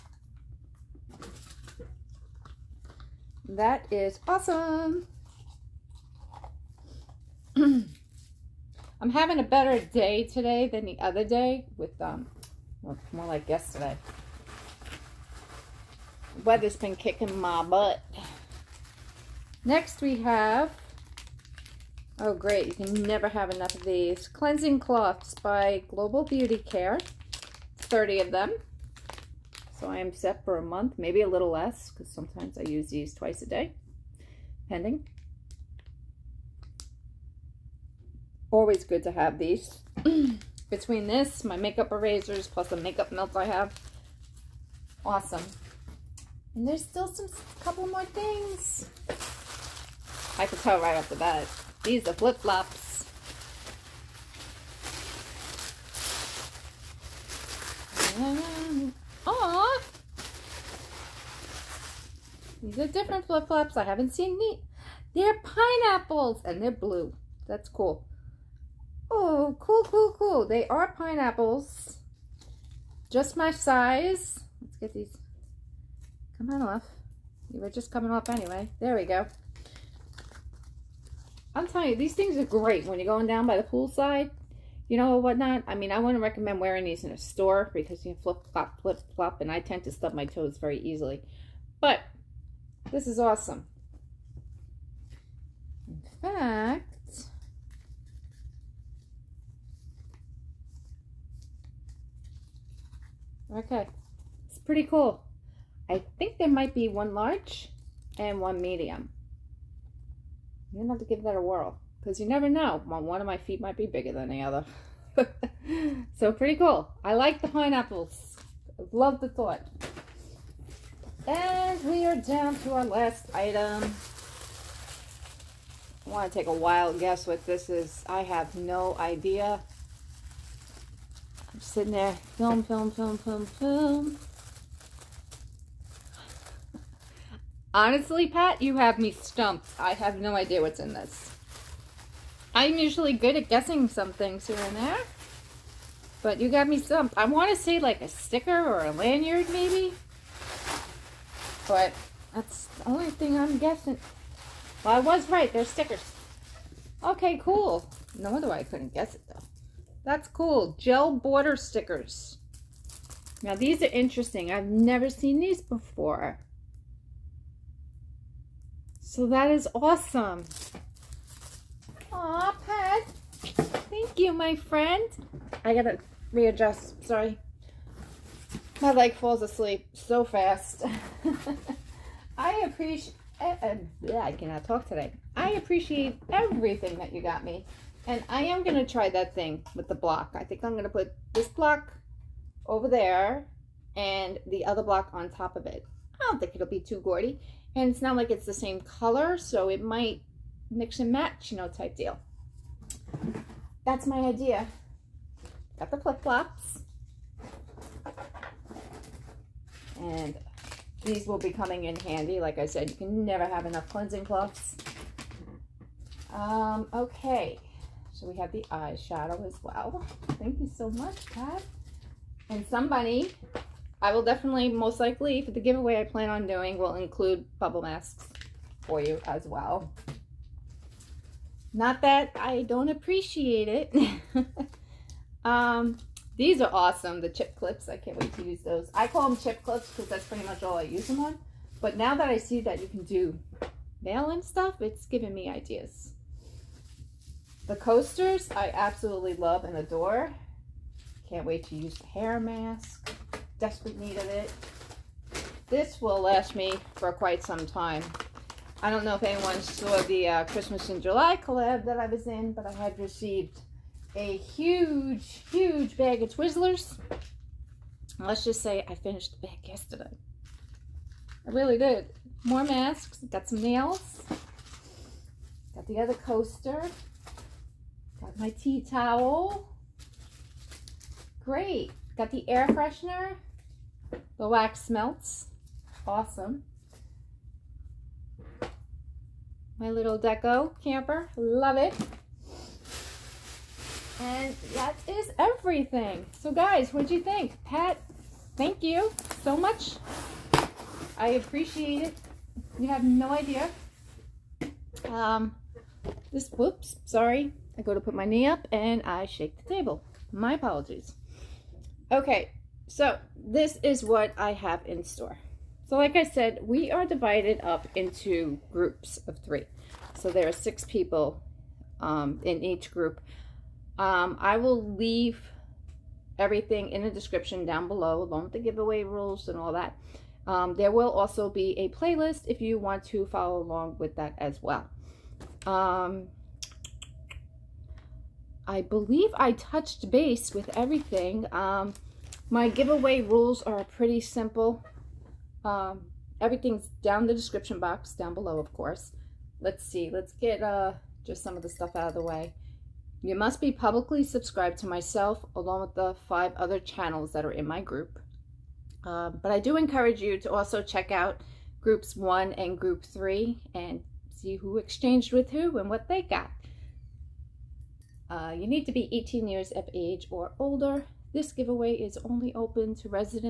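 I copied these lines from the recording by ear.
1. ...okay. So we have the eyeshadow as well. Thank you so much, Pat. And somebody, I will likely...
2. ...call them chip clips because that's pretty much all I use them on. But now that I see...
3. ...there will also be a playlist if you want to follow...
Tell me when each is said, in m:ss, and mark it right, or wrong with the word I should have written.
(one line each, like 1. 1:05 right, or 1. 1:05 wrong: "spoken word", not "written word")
1. 3:36 wrong: "definitely", not "likely"
2. 3:59 right
3. 5:30 right.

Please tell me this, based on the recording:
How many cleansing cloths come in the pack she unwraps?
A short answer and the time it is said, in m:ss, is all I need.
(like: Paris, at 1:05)
30, at 0:27.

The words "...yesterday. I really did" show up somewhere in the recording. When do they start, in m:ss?
4:29.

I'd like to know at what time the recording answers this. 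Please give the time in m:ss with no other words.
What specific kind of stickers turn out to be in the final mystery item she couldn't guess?
2:40.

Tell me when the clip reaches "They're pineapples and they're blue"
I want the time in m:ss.
1:05.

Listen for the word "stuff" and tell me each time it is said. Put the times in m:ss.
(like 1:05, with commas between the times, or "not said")
4:04, 5:51.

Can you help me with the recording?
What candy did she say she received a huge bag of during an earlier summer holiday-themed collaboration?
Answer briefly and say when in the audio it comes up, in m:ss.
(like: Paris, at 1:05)
Twizzlers, at 4:26.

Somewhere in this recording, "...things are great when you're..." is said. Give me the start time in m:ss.
1:22.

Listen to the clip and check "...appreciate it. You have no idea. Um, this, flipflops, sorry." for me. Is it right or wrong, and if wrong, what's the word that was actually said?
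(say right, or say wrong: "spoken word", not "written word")
wrong: "whoops", not "flipflops".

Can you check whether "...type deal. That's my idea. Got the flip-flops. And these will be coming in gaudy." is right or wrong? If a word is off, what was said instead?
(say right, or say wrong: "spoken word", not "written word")
wrong: "handy", not "gaudy".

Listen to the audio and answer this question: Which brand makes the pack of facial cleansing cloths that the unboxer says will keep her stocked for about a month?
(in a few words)
Global Beauty Care.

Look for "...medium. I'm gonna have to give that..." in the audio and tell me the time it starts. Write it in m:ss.
1:48.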